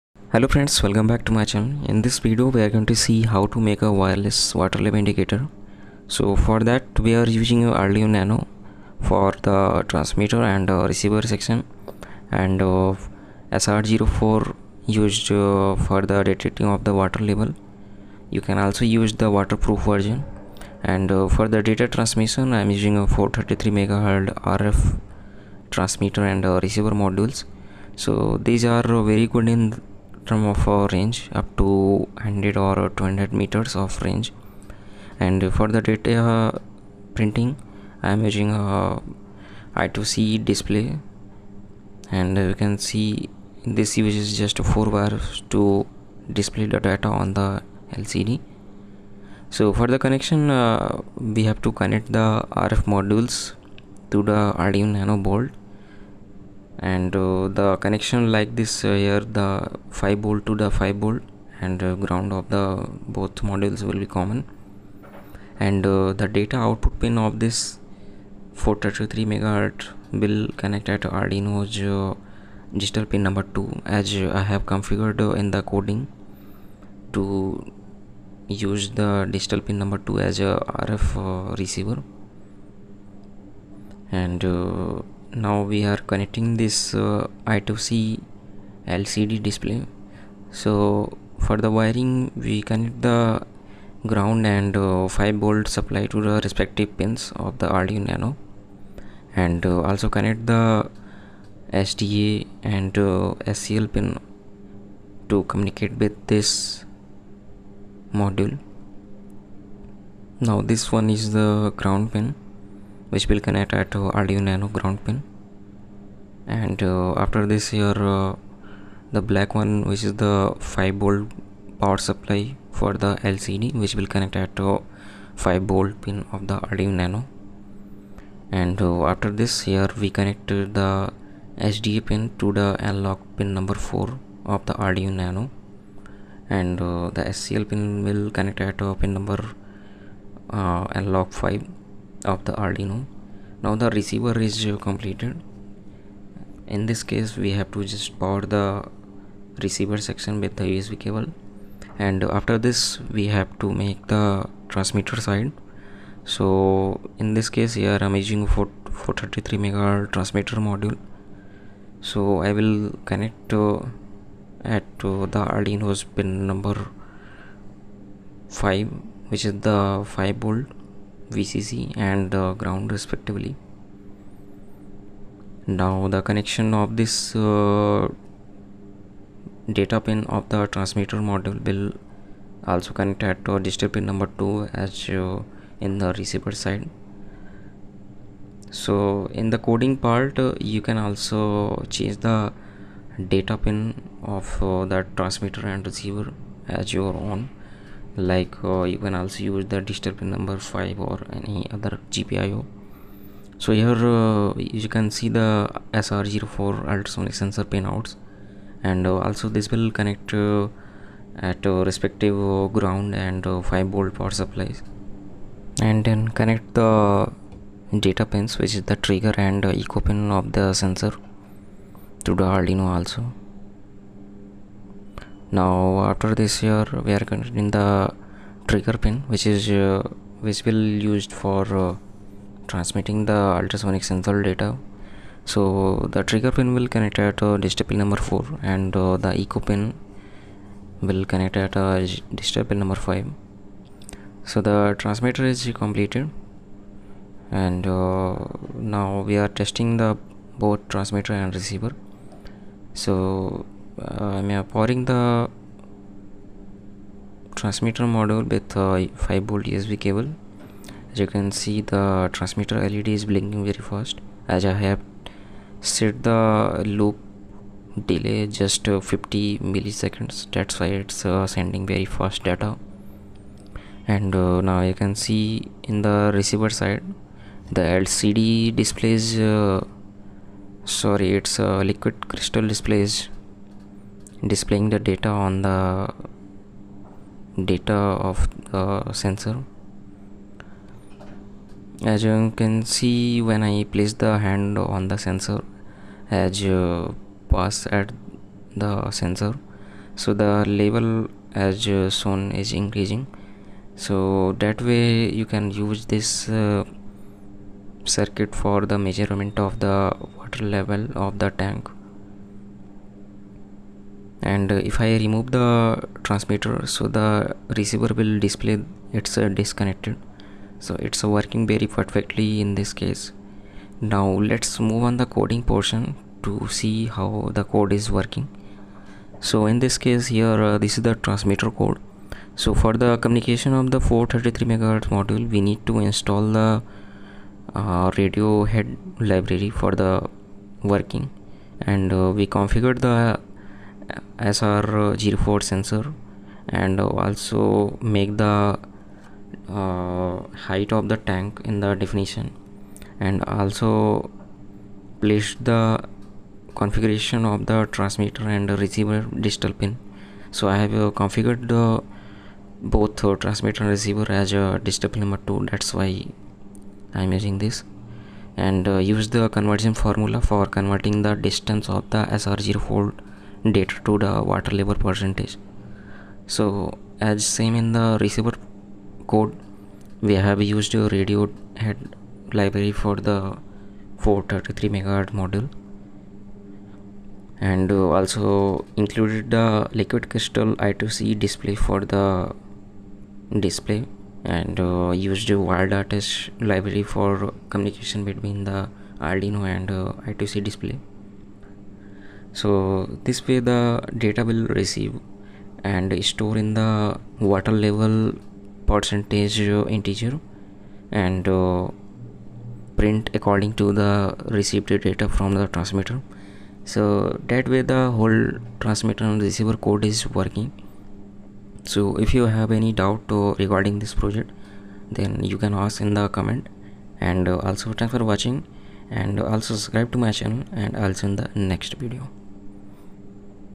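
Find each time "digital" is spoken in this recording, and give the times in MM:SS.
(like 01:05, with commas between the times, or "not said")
01:12, 01:19, 03:03, 05:59, 06:04.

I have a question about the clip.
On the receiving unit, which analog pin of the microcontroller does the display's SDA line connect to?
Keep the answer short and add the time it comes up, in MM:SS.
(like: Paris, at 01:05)
Analog pin 4, at 02:12.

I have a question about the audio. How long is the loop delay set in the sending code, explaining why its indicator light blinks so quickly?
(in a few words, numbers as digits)
50 milliseconds.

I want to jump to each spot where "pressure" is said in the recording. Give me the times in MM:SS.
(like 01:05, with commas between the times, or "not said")
not said.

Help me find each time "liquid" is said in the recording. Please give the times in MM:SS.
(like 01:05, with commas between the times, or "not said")
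04:41, 06:29.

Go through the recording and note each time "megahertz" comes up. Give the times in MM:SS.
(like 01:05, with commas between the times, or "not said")
01:09, 02:39, 06:24.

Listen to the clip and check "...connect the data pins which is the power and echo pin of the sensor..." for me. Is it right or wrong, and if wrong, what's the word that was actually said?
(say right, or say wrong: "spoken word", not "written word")
wrong: "trigger", not "power".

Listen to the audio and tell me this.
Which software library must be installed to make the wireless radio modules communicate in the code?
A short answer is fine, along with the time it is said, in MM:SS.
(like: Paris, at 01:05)
RadioHead, at 05:38.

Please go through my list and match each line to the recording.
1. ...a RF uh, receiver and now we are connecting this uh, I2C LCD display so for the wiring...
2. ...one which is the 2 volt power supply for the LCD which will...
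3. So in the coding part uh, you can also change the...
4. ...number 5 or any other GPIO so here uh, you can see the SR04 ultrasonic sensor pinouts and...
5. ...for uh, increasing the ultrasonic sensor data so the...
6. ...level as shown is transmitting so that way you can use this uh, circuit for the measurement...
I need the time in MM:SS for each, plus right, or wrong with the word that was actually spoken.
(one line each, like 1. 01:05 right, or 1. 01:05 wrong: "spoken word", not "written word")
1. 01:20 right
2. 01:59 wrong: "5", not "2"
3. 03:08 right
4. 03:20 right
5. 03:51 wrong: "transmitting", not "increasing"
6. 05:00 wrong: "increasing", not "transmitting".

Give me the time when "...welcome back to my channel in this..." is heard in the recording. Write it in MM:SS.
00:00.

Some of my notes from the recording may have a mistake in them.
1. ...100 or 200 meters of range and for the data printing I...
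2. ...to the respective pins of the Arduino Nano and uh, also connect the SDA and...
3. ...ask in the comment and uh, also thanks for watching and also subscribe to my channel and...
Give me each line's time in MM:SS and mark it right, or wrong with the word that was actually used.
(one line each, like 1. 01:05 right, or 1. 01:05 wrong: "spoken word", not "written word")
1. 00:32 right
2. 01:36 right
3. 07:05 right.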